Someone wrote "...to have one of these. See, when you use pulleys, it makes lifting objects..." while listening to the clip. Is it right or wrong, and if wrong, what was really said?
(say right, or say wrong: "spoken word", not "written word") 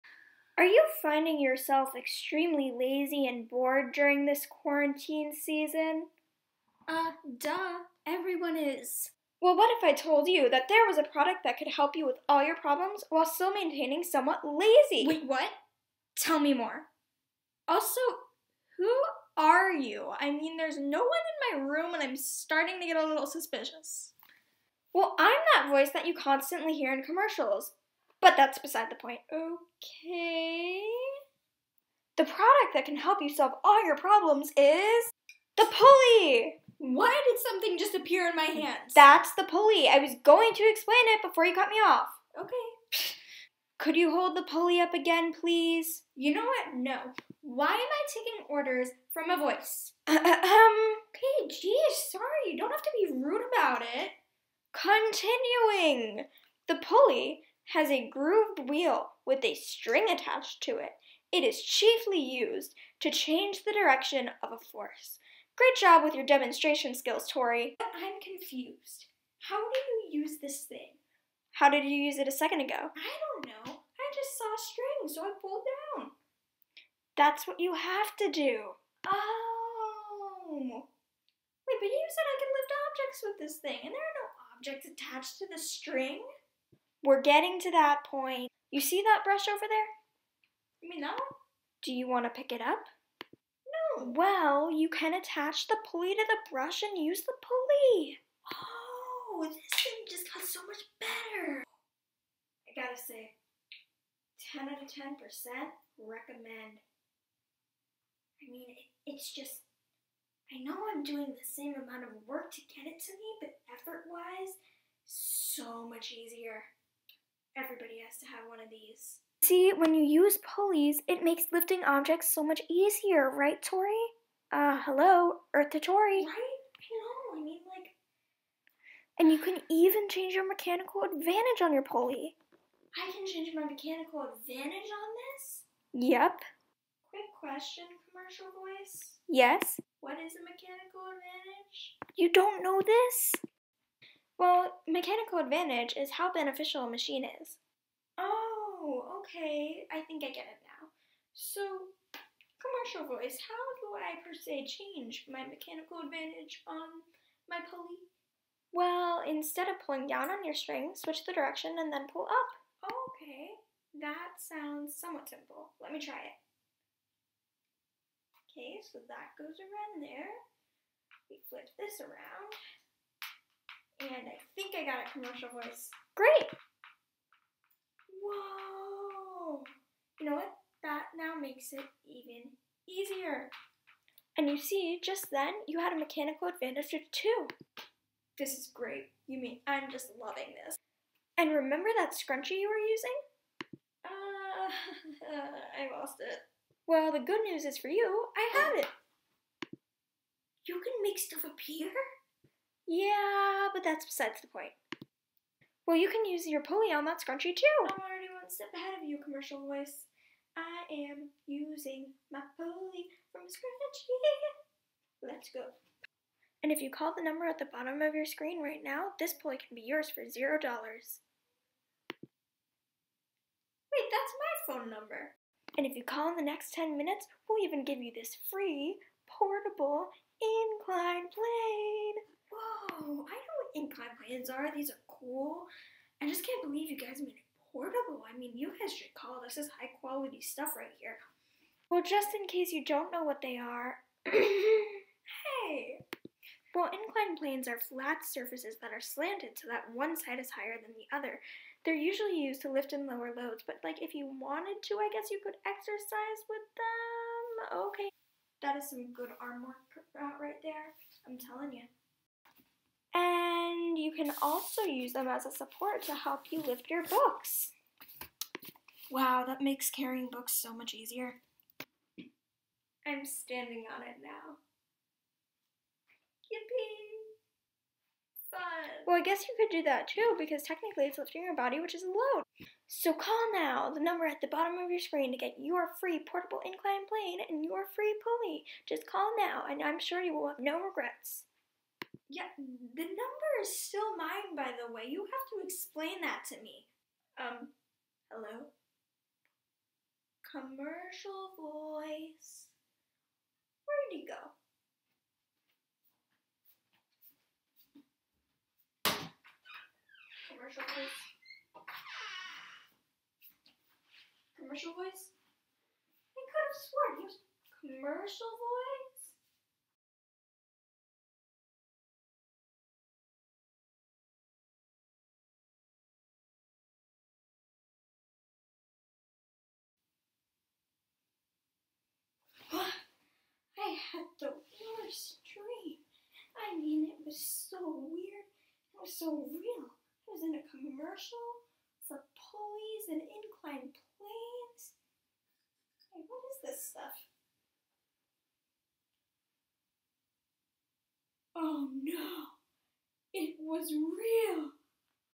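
right.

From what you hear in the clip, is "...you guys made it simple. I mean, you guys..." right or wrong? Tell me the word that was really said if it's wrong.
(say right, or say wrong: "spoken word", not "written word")
wrong: "portable", not "simple".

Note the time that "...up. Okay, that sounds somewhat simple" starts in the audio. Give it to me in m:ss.
2:42.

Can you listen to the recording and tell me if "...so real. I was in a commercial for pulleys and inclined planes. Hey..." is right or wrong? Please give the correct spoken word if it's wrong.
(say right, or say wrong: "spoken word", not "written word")
right.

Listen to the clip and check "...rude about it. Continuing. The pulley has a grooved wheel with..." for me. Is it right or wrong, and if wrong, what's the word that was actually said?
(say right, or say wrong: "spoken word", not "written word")
right.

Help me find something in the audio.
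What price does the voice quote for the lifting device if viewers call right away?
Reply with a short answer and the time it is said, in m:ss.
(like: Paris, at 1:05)
$0, at 3:40.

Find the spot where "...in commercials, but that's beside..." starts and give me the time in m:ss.
0:26.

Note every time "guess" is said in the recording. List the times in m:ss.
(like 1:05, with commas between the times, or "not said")
4:15, 4:39.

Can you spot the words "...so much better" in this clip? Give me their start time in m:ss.
1:40.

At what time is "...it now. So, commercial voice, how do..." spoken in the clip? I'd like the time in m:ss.
2:30.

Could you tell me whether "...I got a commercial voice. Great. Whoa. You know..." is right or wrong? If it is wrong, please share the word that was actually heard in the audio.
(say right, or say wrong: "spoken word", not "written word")
right.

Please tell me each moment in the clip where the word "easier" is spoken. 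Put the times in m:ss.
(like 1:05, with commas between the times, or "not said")
1:56, 2:02, 3:02, 4:30.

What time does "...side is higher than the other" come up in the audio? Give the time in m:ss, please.
4:10.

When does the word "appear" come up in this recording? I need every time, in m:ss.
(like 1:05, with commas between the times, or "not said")
0:37, 3:21.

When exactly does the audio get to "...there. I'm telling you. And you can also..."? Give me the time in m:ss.
4:20.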